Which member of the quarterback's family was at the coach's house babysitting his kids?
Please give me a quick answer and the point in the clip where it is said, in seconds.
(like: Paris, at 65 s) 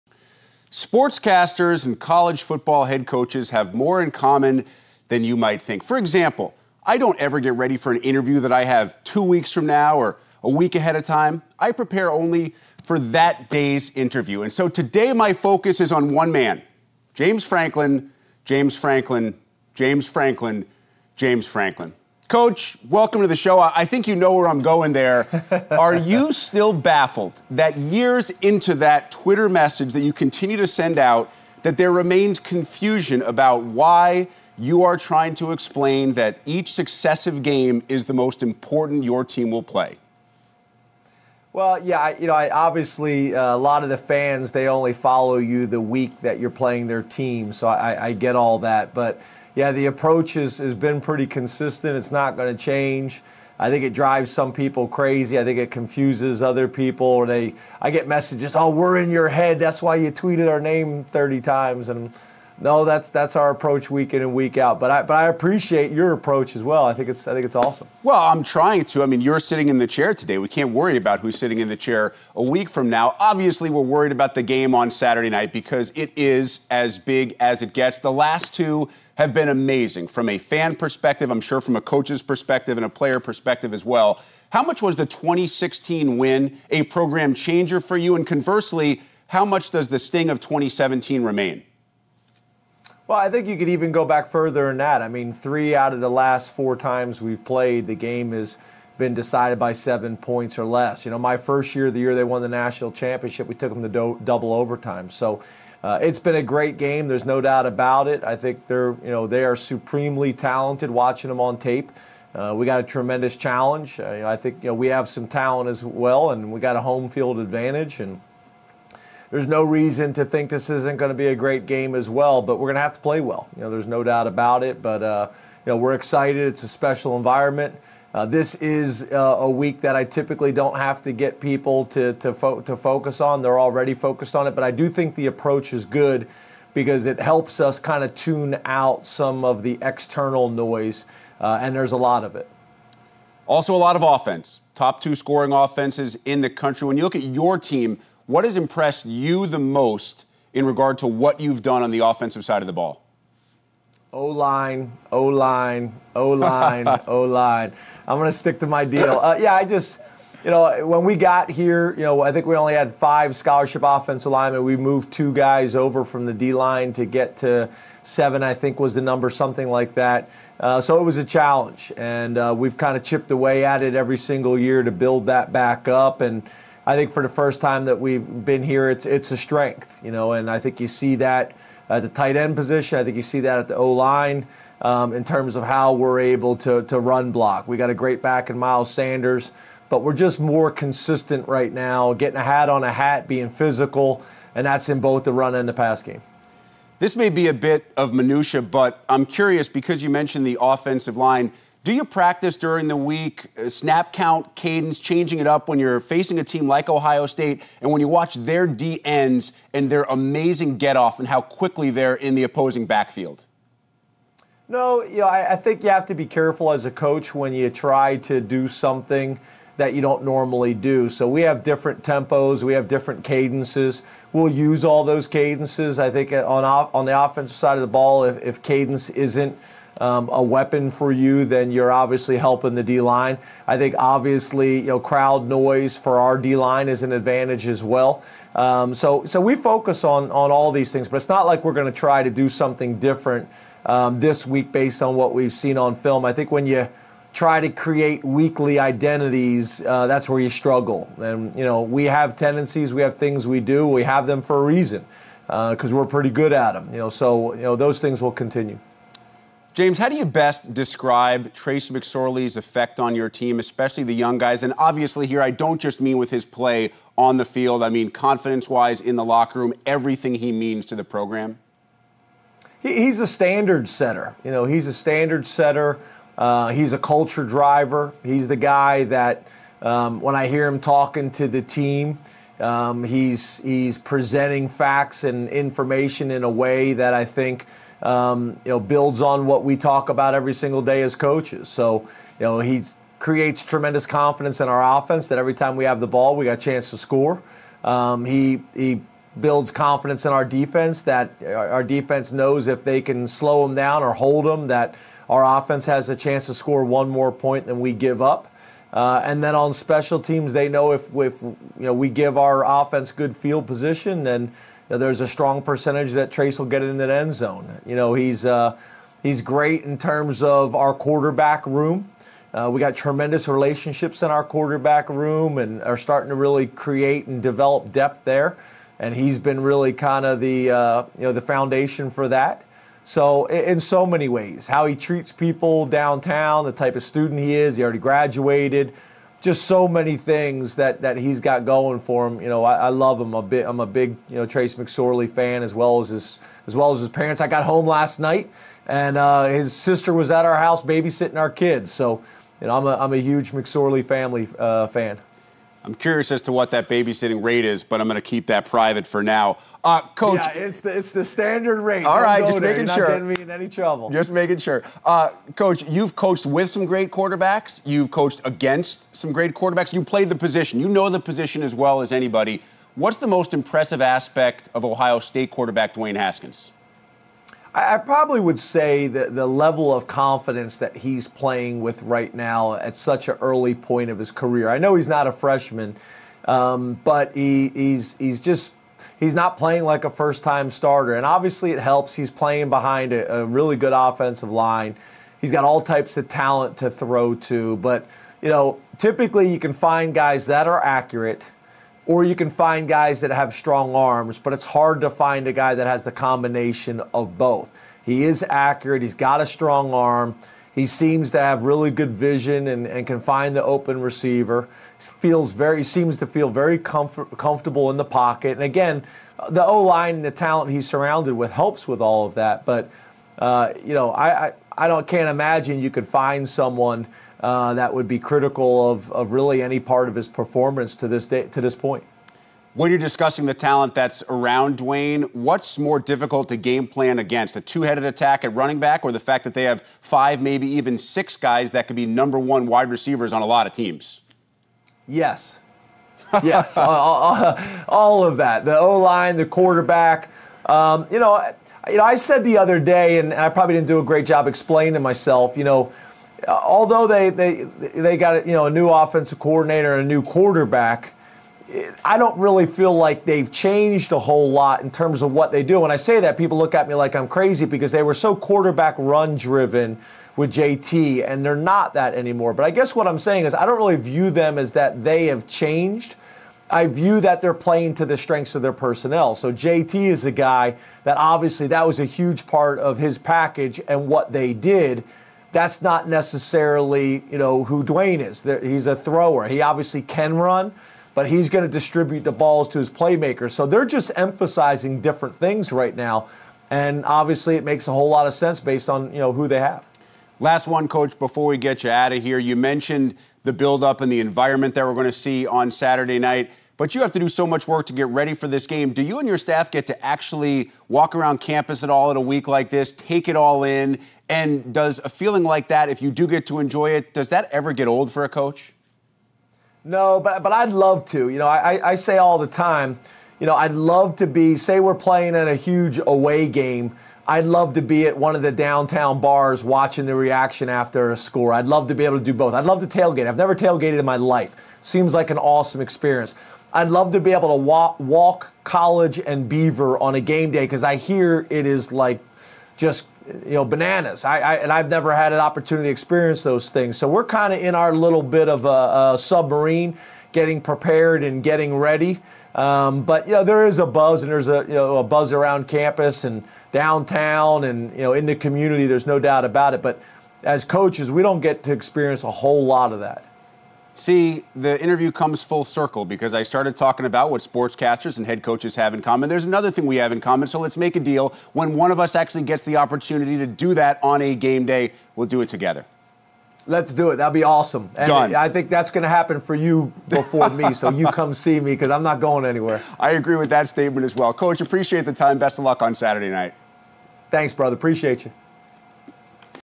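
His sister, at 349 s.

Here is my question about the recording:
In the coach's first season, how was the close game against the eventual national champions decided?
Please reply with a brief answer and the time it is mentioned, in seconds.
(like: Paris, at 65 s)
Double overtime, at 104 s.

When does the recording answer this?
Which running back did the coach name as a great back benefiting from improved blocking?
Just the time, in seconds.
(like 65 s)
188 s.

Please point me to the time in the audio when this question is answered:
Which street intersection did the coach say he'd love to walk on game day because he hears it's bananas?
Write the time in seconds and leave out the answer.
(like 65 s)
538 s.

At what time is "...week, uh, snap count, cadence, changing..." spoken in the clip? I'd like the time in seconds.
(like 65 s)
202 s.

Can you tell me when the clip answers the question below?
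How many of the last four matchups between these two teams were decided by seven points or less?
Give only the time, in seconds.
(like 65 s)
95 s.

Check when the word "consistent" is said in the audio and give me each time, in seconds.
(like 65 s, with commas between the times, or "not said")
51 s, 190 s.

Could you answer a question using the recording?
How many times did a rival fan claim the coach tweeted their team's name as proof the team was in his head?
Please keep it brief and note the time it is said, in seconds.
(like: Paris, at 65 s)
30, at 61 s.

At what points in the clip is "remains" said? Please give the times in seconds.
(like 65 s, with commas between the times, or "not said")
31 s, 91 s.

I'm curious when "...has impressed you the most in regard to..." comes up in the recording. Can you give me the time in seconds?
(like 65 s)
148 s.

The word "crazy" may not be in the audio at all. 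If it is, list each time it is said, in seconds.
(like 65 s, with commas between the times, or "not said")
54 s, 467 s.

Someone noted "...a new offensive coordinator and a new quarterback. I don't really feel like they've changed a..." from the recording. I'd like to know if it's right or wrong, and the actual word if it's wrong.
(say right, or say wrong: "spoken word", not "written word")
right.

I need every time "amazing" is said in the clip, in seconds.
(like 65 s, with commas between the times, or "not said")
79 s, 210 s.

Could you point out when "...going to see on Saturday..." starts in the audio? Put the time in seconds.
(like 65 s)
504 s.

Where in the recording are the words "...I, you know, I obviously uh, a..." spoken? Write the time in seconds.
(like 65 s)
41 s.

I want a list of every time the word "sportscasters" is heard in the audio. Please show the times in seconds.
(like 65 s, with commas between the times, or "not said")
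0 s, 567 s.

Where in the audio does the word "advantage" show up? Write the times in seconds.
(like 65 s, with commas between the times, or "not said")
117 s, 237 s.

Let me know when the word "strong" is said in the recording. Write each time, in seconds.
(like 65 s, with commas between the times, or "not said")
315 s, 403 s, 409 s.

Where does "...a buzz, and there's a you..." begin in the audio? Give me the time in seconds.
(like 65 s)
553 s.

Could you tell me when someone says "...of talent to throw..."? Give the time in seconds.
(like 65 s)
396 s.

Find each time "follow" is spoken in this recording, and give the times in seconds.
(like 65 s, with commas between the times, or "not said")
44 s.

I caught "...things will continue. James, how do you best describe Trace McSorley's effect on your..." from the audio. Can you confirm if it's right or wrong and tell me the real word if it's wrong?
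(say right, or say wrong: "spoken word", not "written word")
right.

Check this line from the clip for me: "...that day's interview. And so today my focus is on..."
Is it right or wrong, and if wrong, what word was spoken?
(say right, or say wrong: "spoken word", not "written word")
right.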